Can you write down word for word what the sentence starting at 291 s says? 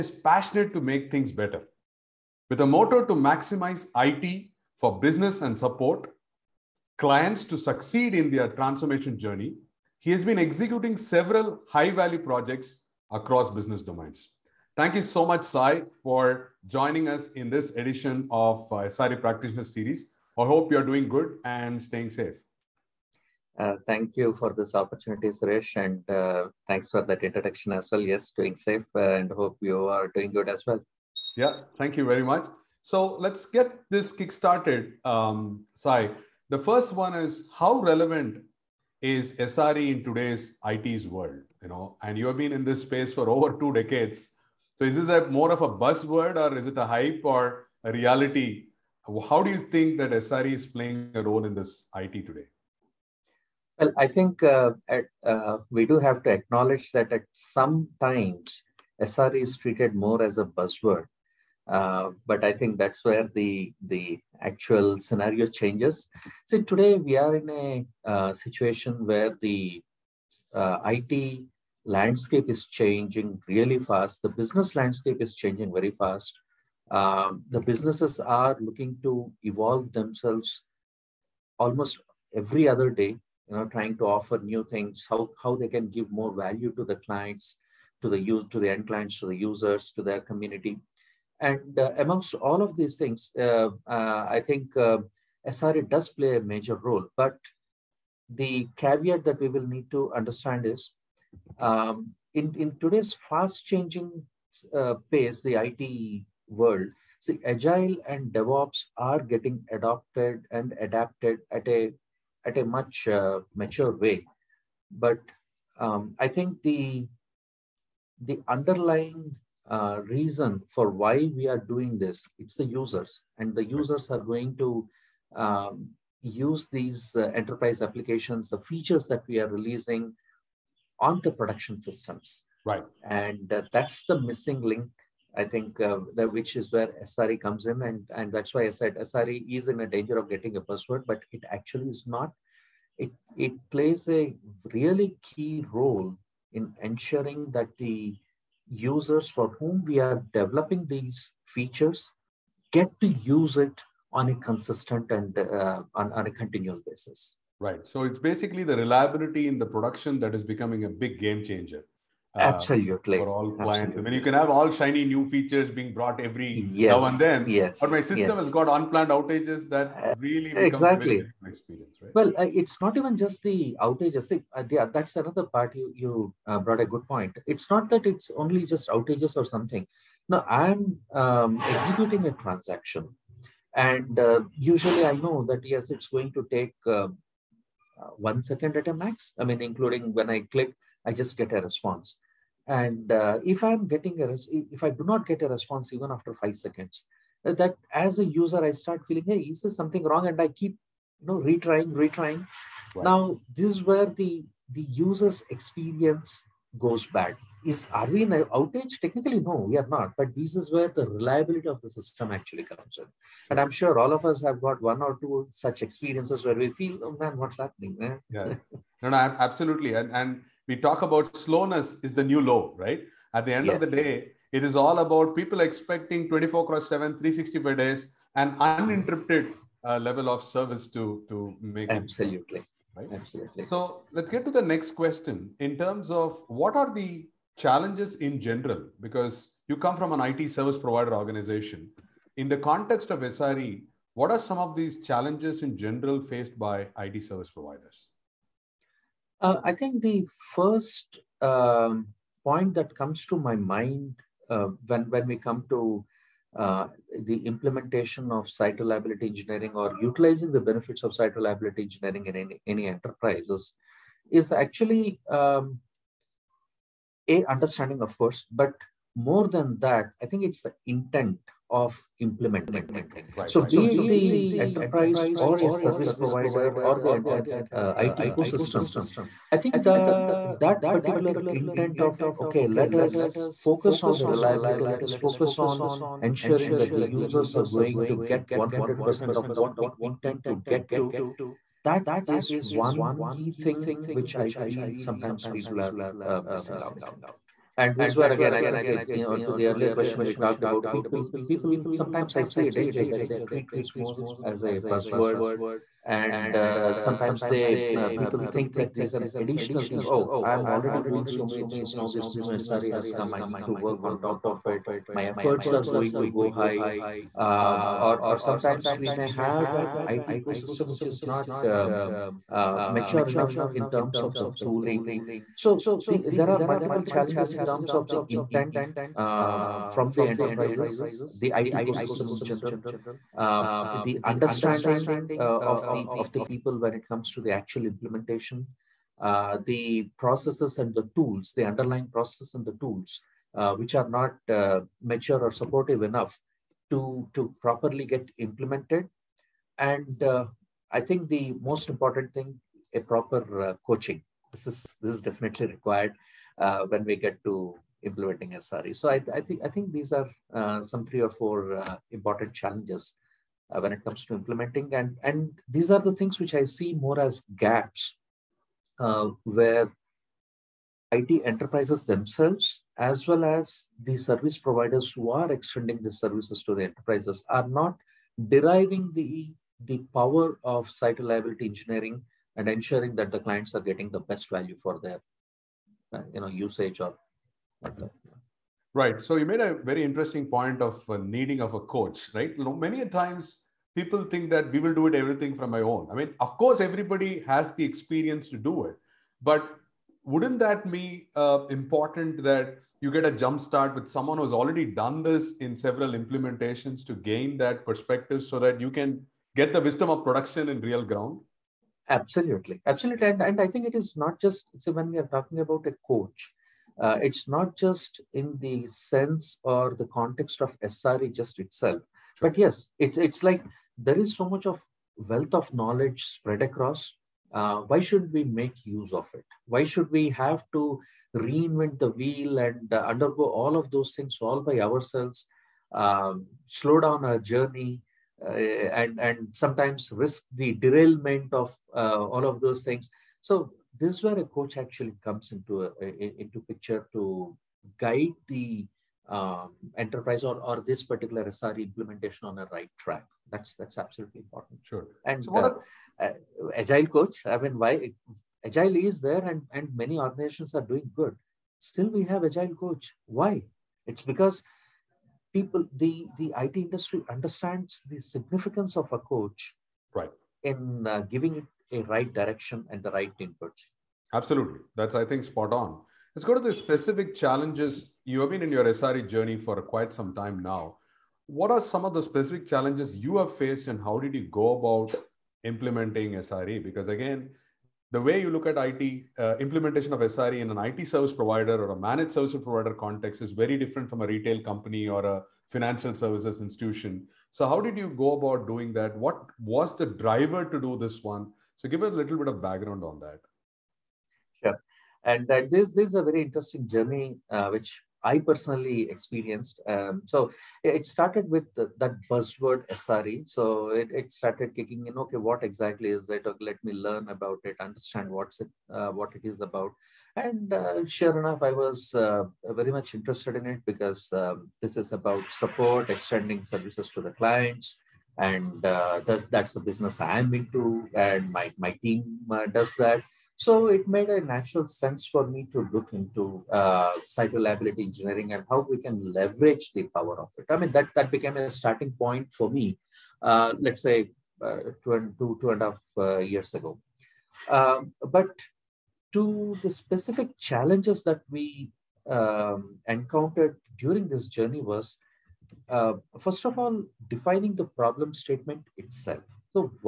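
That is one key thing which I feel sometimes people are uh, missing out.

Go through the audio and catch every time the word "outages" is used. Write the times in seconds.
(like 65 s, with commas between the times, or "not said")
169 s, 173 s, 178 s, 208 s.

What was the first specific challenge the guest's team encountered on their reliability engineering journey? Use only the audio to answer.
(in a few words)
defining the problem statement.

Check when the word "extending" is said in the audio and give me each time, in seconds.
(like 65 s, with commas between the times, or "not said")
375 s, 526 s.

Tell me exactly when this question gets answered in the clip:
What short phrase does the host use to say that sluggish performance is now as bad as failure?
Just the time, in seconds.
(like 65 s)
221 s.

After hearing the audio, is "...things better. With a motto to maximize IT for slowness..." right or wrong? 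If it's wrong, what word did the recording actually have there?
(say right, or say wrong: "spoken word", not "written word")
wrong: "business", not "slowness".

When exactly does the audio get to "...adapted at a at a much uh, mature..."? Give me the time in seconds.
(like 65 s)
110 s.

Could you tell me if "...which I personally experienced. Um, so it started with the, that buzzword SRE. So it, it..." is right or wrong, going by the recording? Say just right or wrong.
right.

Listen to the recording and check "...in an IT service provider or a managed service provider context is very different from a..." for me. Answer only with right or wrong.
right.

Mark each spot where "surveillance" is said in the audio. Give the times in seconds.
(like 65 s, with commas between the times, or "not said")
not said.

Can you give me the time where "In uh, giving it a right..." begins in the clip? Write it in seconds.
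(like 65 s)
470 s.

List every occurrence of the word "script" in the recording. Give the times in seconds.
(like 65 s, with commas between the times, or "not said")
not said.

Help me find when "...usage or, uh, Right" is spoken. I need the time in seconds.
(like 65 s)
386 s.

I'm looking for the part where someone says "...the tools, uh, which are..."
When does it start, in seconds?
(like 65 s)
342 s.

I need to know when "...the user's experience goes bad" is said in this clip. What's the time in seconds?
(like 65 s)
204 s.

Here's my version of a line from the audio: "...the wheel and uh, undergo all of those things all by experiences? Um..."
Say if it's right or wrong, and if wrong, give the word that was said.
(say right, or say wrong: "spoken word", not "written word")
wrong: "ourselves", not "experiences".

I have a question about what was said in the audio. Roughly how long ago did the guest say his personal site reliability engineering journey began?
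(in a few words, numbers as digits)
2.5 years.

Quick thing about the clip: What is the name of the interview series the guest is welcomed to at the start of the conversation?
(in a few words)
SRE Practitioner Series.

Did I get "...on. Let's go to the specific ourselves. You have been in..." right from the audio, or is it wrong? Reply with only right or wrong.
wrong.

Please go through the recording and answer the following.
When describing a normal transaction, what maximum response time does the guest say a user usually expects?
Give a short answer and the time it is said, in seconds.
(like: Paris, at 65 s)
1 second, at 188 s.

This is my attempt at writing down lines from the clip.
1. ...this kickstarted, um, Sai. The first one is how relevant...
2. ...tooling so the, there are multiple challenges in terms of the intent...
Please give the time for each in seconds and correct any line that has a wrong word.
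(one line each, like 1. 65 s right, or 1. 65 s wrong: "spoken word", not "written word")
1. 33 s right
2. 324 s right.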